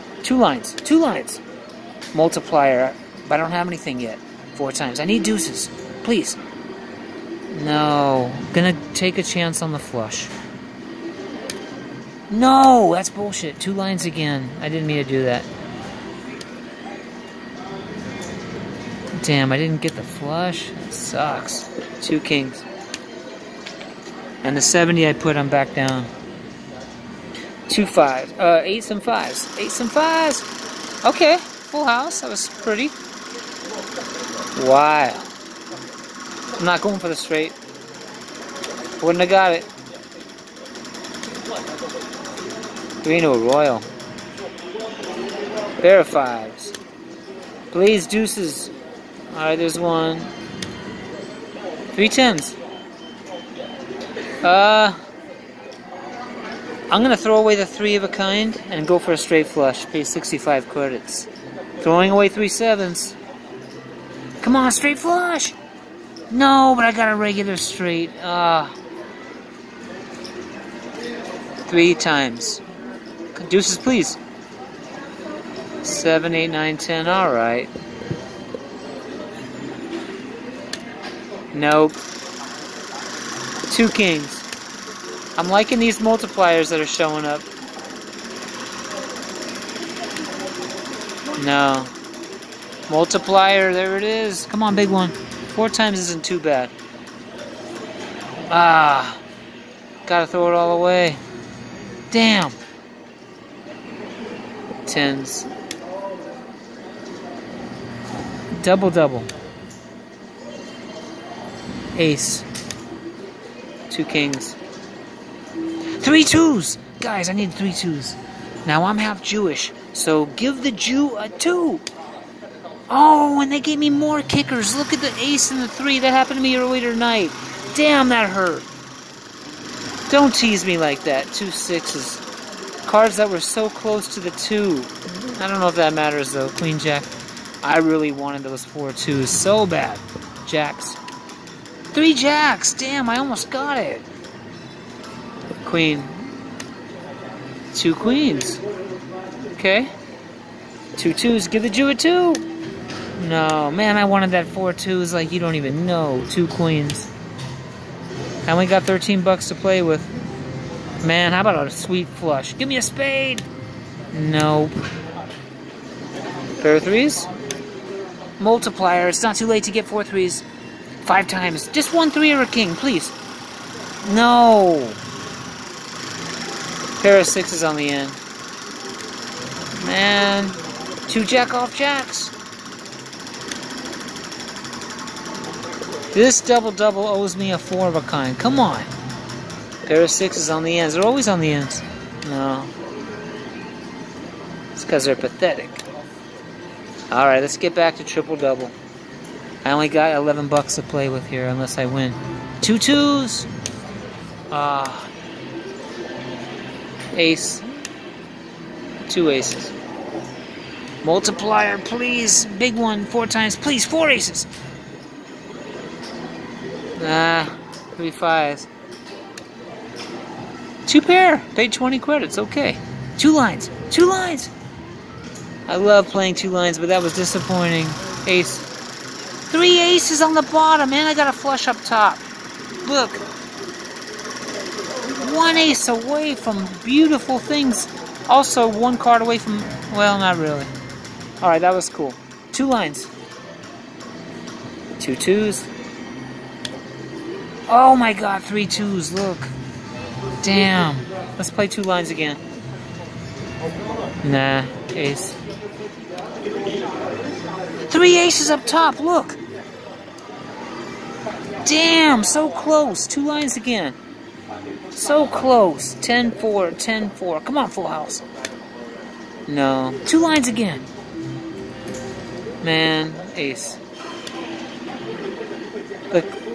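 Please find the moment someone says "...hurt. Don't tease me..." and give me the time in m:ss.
2:08.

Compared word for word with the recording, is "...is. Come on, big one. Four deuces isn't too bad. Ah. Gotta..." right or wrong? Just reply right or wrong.
wrong.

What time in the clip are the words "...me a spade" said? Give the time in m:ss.
2:42.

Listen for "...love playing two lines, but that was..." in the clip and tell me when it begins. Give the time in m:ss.
3:45.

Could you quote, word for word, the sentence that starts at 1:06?
No, but I got a regular straight.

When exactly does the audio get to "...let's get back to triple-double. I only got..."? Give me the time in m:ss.
3:17.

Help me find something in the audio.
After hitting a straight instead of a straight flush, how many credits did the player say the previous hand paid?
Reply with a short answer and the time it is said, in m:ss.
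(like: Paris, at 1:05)
65, at 1:00.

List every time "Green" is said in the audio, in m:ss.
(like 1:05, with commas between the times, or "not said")
0:43.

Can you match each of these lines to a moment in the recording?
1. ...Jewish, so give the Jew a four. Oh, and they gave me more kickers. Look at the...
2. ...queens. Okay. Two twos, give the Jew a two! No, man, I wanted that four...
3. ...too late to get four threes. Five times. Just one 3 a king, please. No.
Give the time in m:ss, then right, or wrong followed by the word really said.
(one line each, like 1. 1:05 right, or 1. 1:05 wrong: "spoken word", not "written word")
1. 1:59 wrong: "two", not "four"
2. 2:27 right
3. 2:49 right.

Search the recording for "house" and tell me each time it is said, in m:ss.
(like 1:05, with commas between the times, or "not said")
0:31, 4:27.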